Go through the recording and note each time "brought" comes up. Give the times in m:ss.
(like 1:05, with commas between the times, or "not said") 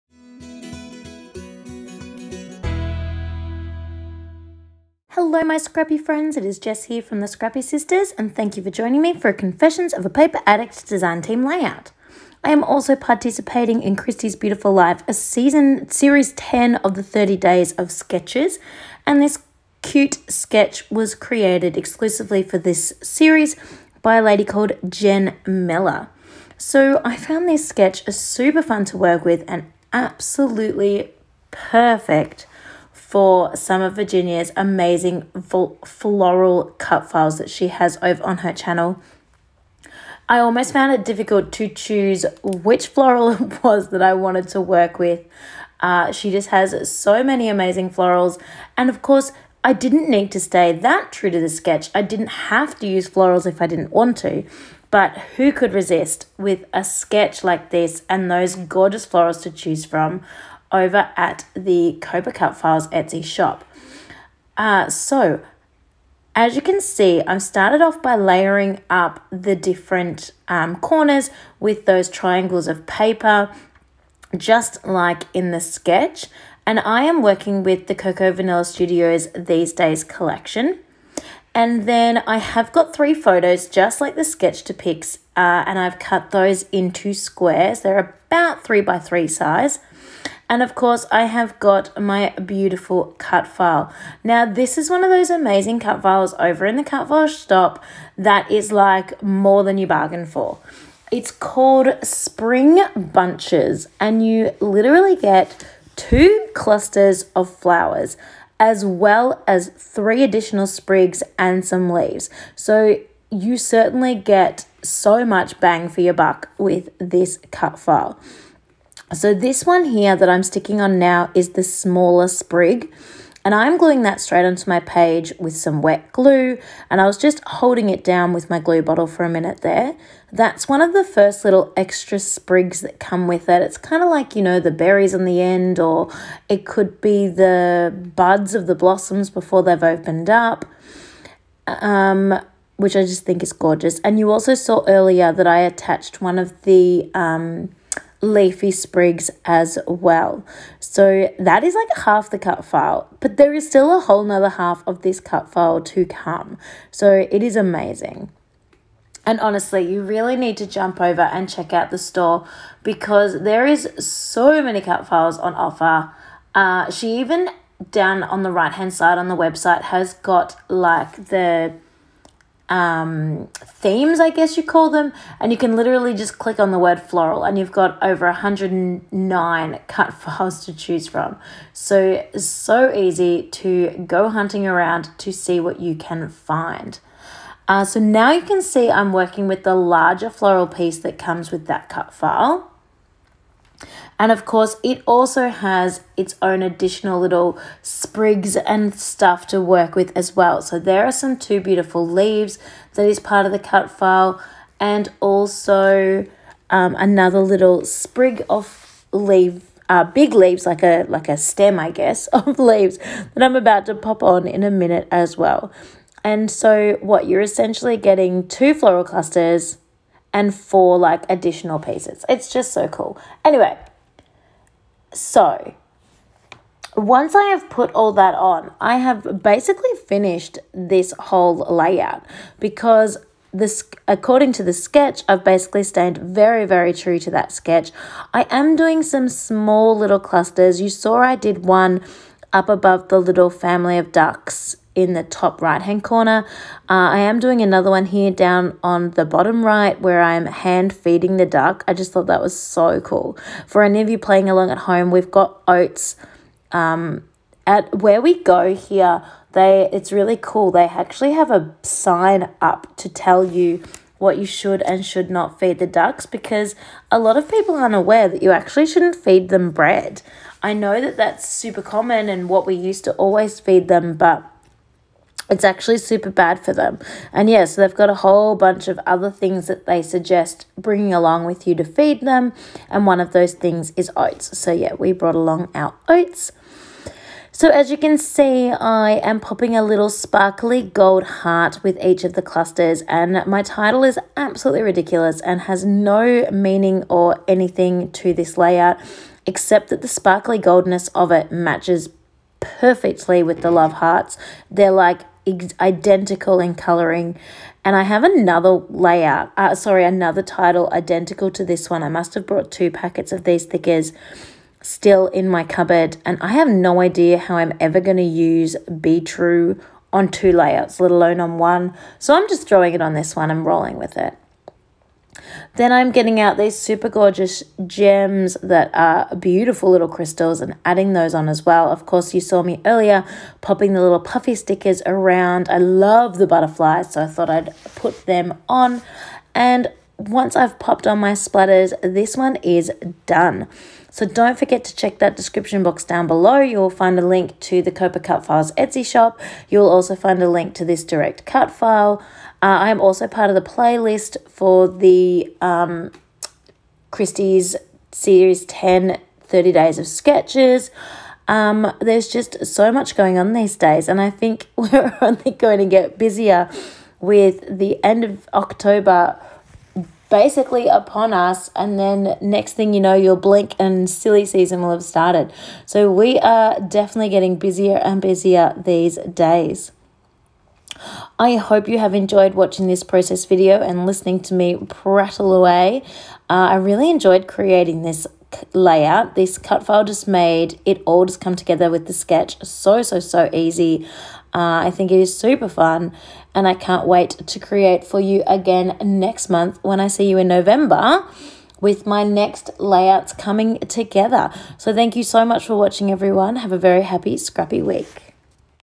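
4:45, 5:12.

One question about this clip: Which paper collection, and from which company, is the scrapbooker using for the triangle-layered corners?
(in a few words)
Cocoa Vanilla Studios These Days.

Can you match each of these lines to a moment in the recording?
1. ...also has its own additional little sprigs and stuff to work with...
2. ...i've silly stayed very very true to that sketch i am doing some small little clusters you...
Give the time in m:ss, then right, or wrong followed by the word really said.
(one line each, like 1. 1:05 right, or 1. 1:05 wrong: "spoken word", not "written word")
1. 3:15 right
2. 3:55 wrong: "basically", not "silly".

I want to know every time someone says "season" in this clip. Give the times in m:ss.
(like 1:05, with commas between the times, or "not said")
0:15, 6:14.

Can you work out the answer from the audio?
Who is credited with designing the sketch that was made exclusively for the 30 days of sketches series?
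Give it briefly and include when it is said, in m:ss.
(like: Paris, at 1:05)
Jen Miller, at 0:24.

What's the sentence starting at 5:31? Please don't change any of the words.
Of course, you saw me earlier popping the little puffy stickers around.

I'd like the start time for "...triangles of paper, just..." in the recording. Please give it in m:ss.
1:12.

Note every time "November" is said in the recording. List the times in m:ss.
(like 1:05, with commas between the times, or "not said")
6:40.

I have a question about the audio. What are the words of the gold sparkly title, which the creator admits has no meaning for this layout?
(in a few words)
Be True.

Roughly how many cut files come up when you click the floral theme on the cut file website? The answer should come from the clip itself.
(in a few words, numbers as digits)
109.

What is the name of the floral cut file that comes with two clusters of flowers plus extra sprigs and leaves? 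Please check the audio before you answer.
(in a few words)
Spring Bunches.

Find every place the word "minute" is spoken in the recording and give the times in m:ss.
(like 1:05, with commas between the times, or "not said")
2:09, 3:34.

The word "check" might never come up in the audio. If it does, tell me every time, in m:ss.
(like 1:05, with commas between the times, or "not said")
2:41, 5:44.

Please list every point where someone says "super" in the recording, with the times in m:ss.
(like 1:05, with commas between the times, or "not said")
0:28, 4:31, 4:35, 5:26, 6:35.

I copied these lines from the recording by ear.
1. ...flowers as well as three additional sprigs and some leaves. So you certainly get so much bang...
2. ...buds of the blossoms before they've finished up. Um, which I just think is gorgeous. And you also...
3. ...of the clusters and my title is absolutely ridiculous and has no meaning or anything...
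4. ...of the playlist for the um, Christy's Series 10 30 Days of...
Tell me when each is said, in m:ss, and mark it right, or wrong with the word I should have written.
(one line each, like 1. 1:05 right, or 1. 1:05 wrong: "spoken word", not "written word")
1. 1:47 right
2. 2:18 wrong: "opened", not "finished"
3. 4:52 right
4. 5:53 right.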